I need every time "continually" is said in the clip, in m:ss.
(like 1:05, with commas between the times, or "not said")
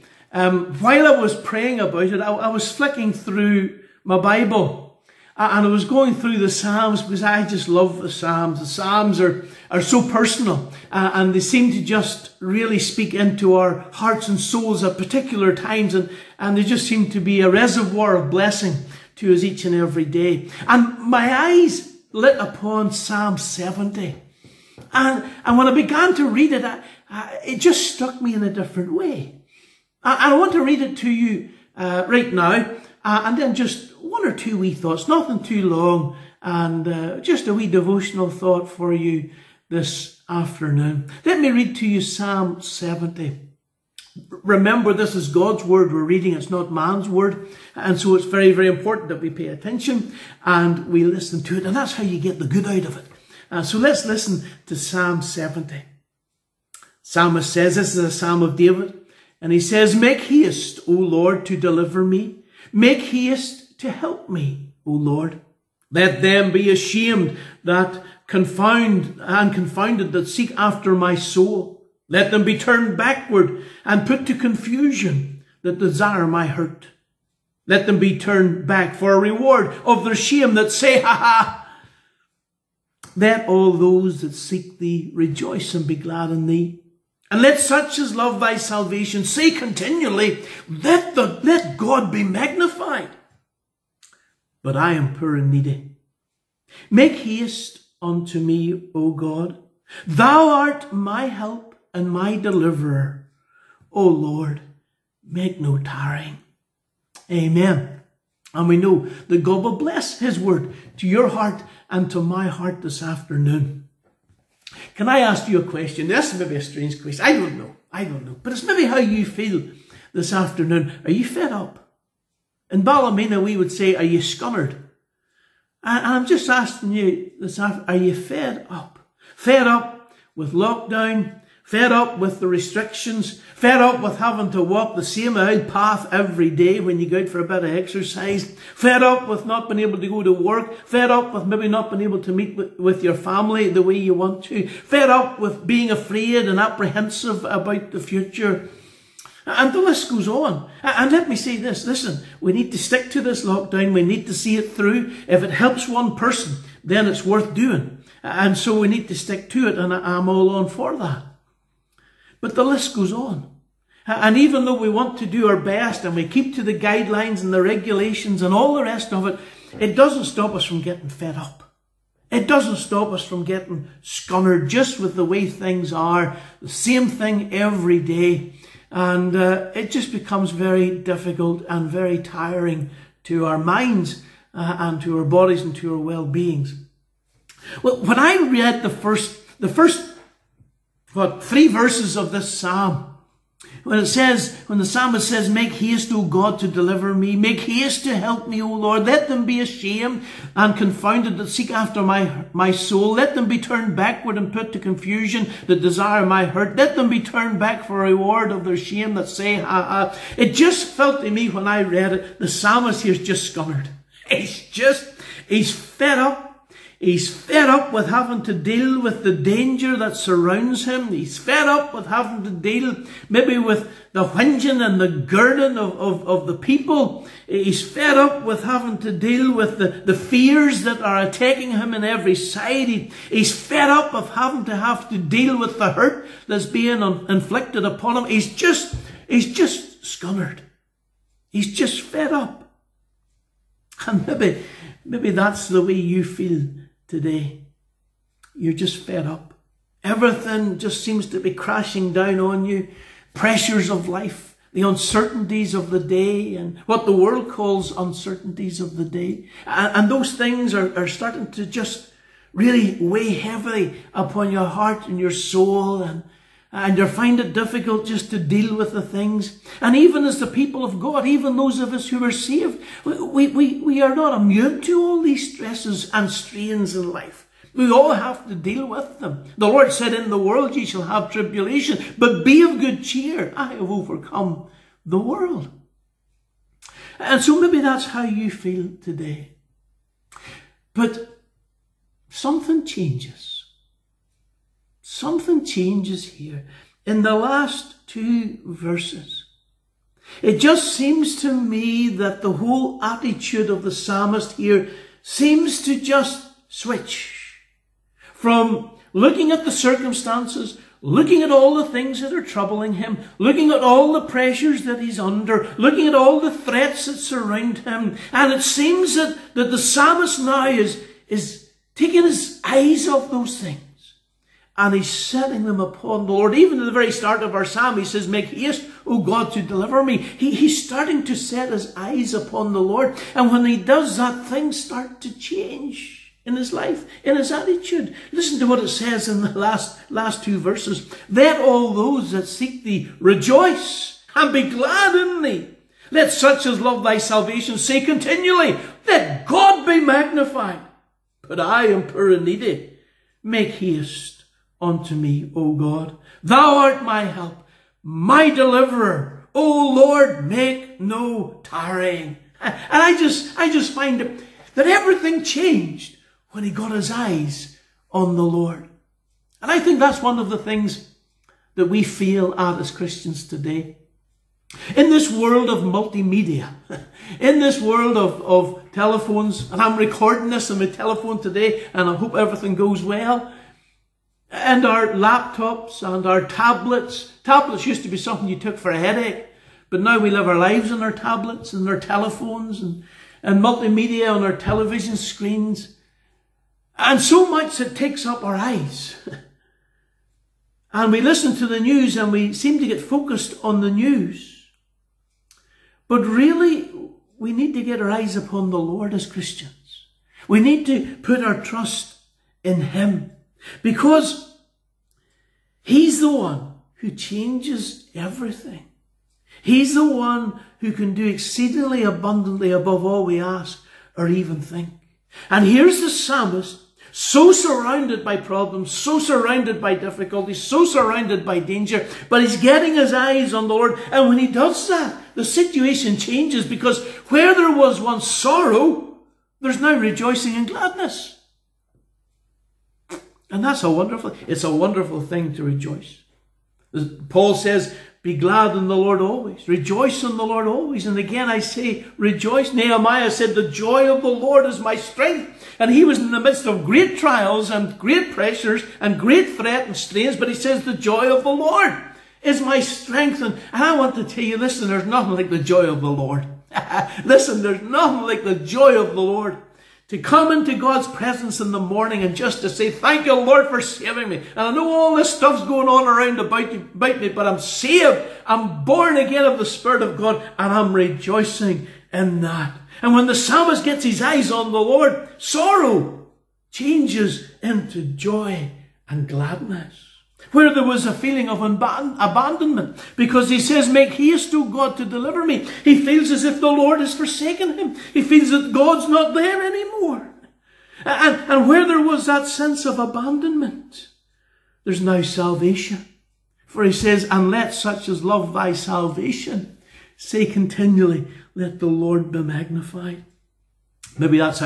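1:29, 5:48, 8:30.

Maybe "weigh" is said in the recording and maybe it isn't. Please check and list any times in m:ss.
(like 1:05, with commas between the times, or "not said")
4:22.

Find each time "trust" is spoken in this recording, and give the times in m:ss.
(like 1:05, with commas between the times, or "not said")
6:51.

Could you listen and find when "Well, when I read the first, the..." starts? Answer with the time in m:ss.
3:07.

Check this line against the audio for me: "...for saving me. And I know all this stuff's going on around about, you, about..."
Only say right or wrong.
right.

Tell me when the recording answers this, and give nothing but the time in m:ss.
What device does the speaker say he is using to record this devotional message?
6:20.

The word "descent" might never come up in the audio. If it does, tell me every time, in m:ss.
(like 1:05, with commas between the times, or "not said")
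not said.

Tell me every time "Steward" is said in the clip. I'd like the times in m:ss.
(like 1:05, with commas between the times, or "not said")
not said.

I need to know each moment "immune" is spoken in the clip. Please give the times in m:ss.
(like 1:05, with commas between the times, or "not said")
4:34.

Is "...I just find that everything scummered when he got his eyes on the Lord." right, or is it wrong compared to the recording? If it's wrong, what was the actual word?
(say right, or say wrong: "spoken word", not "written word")
wrong: "changed", not "scummered".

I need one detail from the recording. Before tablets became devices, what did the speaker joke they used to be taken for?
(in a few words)
a headache.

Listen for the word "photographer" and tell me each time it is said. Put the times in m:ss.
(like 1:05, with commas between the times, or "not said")
not said.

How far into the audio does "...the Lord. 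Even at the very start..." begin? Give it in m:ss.
5:26.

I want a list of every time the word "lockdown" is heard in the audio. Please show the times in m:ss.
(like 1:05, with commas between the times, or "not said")
2:10, 2:33.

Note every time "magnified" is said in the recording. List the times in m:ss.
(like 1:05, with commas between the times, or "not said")
1:32, 5:50, 8:32.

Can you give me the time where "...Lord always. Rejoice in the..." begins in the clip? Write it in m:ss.
7:28.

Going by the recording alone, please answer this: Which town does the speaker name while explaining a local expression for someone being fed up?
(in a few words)
Ballymena.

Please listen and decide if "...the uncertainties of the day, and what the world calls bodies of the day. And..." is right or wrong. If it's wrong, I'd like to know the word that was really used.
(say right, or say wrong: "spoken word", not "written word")
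wrong: "uncertainties", not "bodies".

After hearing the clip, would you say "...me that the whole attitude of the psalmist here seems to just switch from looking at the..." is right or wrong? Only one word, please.
right.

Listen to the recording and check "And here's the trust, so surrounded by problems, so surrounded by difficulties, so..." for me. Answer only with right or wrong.
wrong.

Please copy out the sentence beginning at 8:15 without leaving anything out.
He feels as if the Lord has forsaken him.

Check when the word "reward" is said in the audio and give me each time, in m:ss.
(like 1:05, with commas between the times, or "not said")
1:19, 3:28.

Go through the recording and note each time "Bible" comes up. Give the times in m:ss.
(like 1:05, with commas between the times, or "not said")
0:04.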